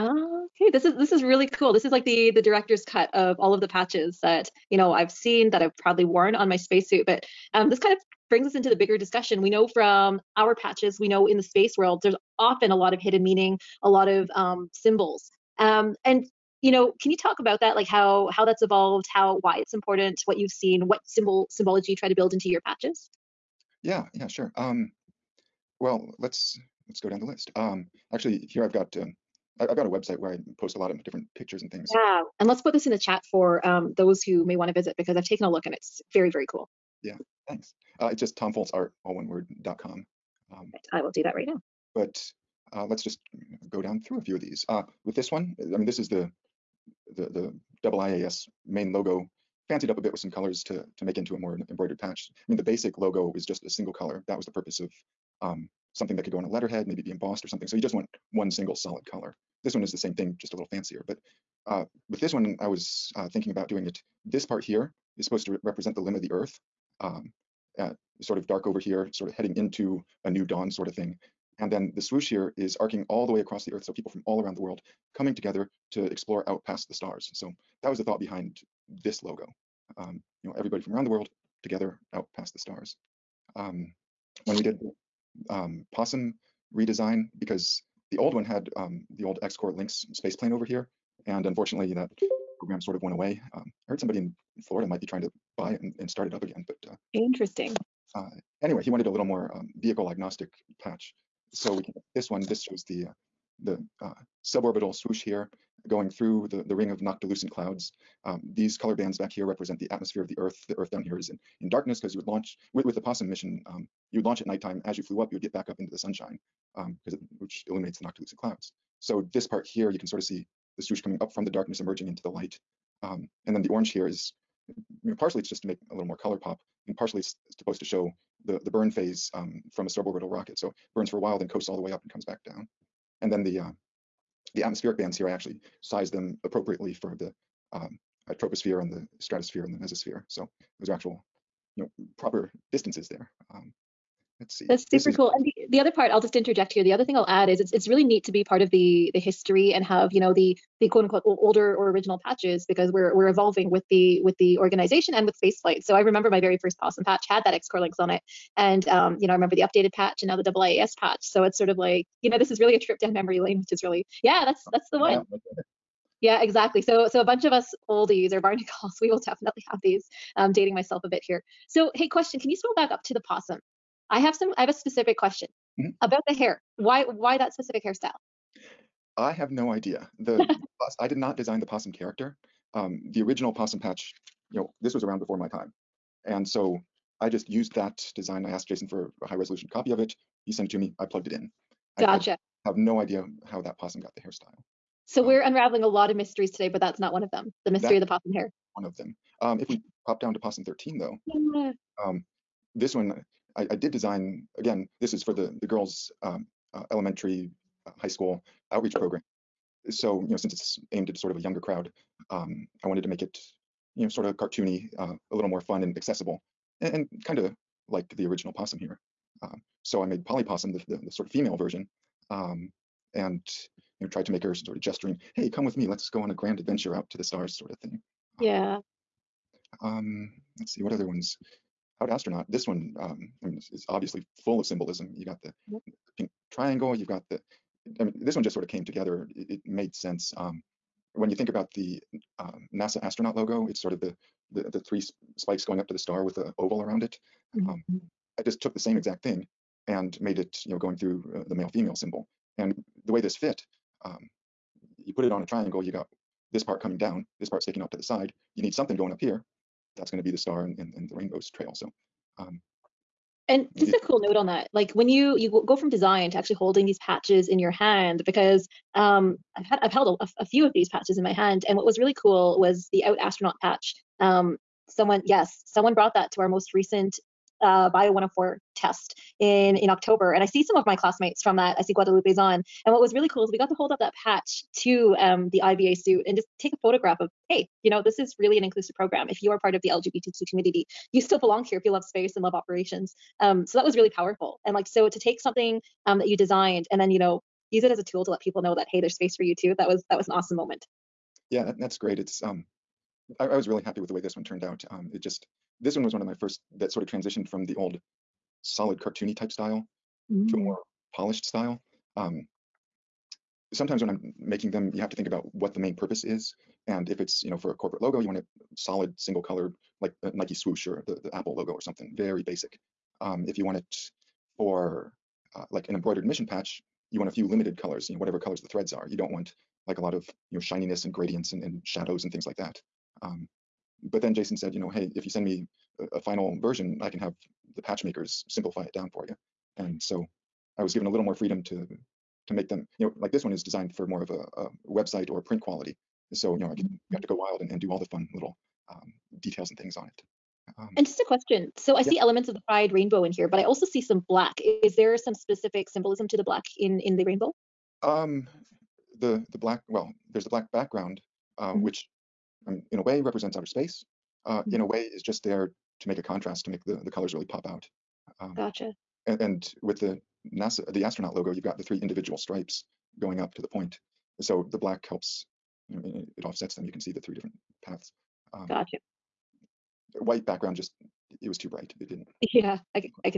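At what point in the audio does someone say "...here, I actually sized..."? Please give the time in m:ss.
2:15.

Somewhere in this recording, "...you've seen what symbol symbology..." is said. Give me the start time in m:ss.
0:20.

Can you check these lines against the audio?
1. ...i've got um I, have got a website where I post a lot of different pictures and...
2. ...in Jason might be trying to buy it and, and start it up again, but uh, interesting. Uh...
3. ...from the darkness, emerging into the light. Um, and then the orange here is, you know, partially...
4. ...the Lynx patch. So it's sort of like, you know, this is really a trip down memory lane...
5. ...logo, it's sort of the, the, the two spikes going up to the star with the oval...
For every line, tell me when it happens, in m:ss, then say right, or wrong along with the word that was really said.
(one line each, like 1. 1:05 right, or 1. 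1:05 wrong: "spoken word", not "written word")
1. 0:28 right
2. 1:34 wrong: "Florida", not "Jason"
3. 2:01 right
4. 2:40 wrong: "IIAS", not "Lynx"
5. 4:03 wrong: "three", not "two".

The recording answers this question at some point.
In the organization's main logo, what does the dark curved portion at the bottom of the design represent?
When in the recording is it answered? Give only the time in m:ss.
1:05.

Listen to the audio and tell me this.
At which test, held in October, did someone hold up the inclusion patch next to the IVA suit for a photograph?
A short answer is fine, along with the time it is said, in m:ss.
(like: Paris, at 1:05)
Bio 104, at 4:37.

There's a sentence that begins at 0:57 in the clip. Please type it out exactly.
So you just want one single solid color.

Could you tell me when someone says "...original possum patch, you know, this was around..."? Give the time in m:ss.
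3:03.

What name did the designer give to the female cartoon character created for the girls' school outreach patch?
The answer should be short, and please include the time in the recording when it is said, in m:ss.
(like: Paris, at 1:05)
Polly, at 3:40.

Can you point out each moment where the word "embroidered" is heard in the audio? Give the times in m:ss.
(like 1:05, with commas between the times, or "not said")
0:51, 5:25.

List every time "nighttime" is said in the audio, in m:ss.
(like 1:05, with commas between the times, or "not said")
1:54.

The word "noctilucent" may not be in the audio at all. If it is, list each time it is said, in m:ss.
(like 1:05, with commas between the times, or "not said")
1:46, 1:58.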